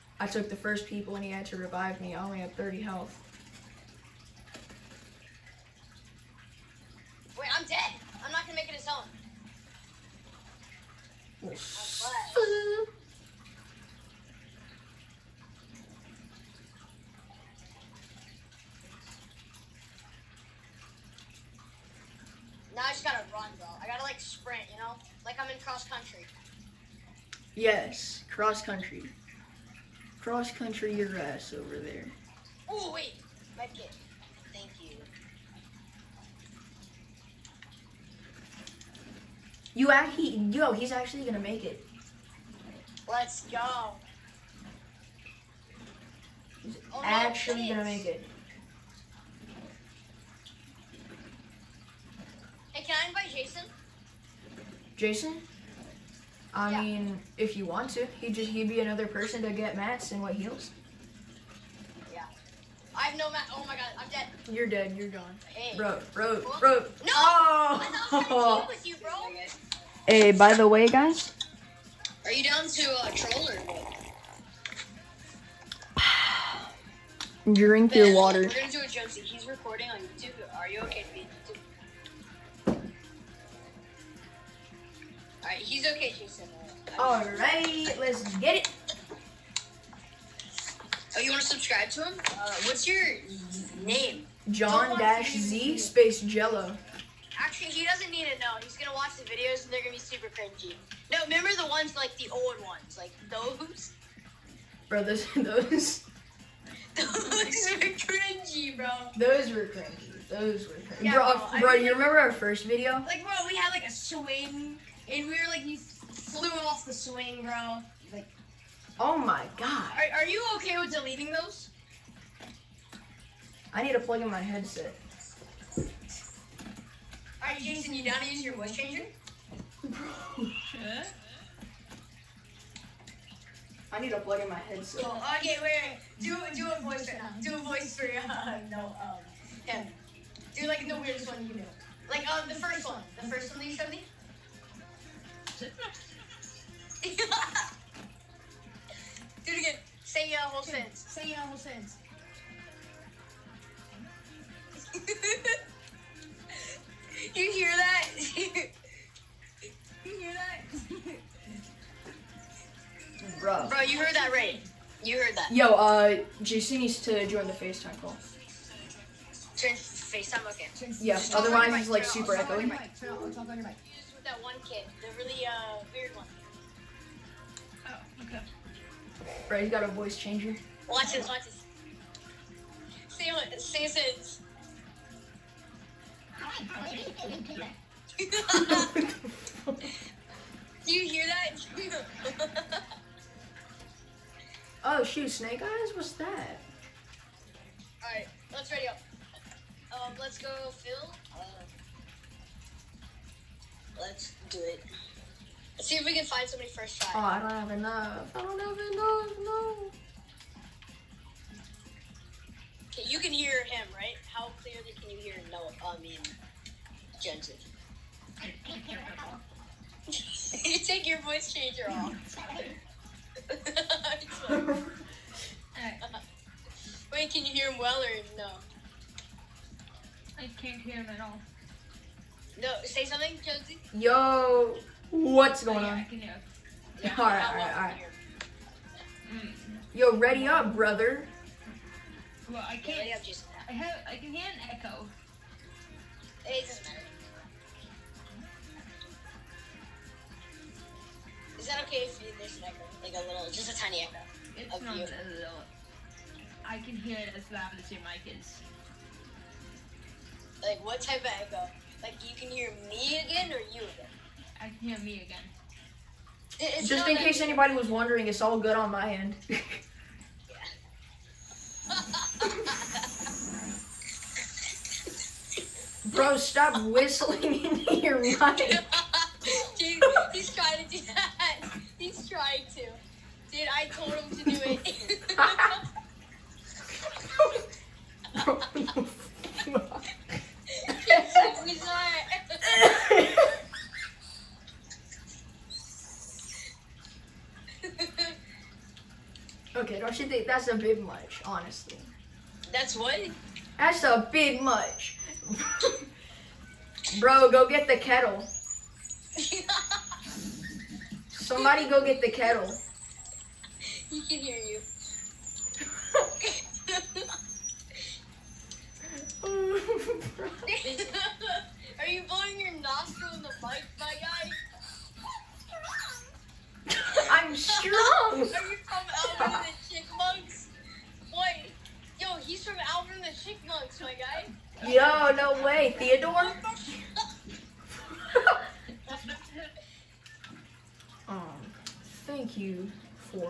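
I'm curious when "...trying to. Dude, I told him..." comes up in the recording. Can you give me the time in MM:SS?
04:42.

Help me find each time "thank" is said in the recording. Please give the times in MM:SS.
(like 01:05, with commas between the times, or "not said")
00:34, 05:42.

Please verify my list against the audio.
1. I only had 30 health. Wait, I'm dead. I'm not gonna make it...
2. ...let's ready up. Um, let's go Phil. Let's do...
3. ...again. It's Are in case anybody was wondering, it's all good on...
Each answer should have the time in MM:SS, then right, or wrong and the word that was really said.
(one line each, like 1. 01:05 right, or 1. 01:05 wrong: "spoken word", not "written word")
1. 00:02 right
2. 03:18 right
3. 04:25 wrong: "Just", not "Are".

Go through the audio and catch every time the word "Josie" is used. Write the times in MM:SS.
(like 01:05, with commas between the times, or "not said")
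03:53.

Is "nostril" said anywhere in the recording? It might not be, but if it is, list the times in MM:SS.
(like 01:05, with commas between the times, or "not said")
05:22.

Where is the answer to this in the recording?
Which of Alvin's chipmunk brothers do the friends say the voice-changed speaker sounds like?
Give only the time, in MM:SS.
05:35.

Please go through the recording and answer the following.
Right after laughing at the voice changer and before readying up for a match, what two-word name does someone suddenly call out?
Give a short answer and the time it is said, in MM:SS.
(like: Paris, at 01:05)
Snake Eyes, at 03:15.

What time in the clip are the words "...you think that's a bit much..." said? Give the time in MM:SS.
05:00.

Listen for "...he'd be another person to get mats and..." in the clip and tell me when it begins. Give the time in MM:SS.
00:58.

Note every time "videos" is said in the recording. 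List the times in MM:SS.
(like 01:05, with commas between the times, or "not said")
01:39, 01:52.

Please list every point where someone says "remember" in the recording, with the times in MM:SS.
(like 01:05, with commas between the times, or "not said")
01:41, 01:51.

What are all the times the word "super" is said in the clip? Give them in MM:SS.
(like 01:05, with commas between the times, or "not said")
01:39, 02:52.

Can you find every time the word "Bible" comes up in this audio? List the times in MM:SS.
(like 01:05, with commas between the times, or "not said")
not said.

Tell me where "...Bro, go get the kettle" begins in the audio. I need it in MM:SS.
05:07.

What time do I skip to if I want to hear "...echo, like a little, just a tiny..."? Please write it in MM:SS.
04:12.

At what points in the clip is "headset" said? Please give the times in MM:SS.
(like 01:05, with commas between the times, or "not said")
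02:04, 02:14.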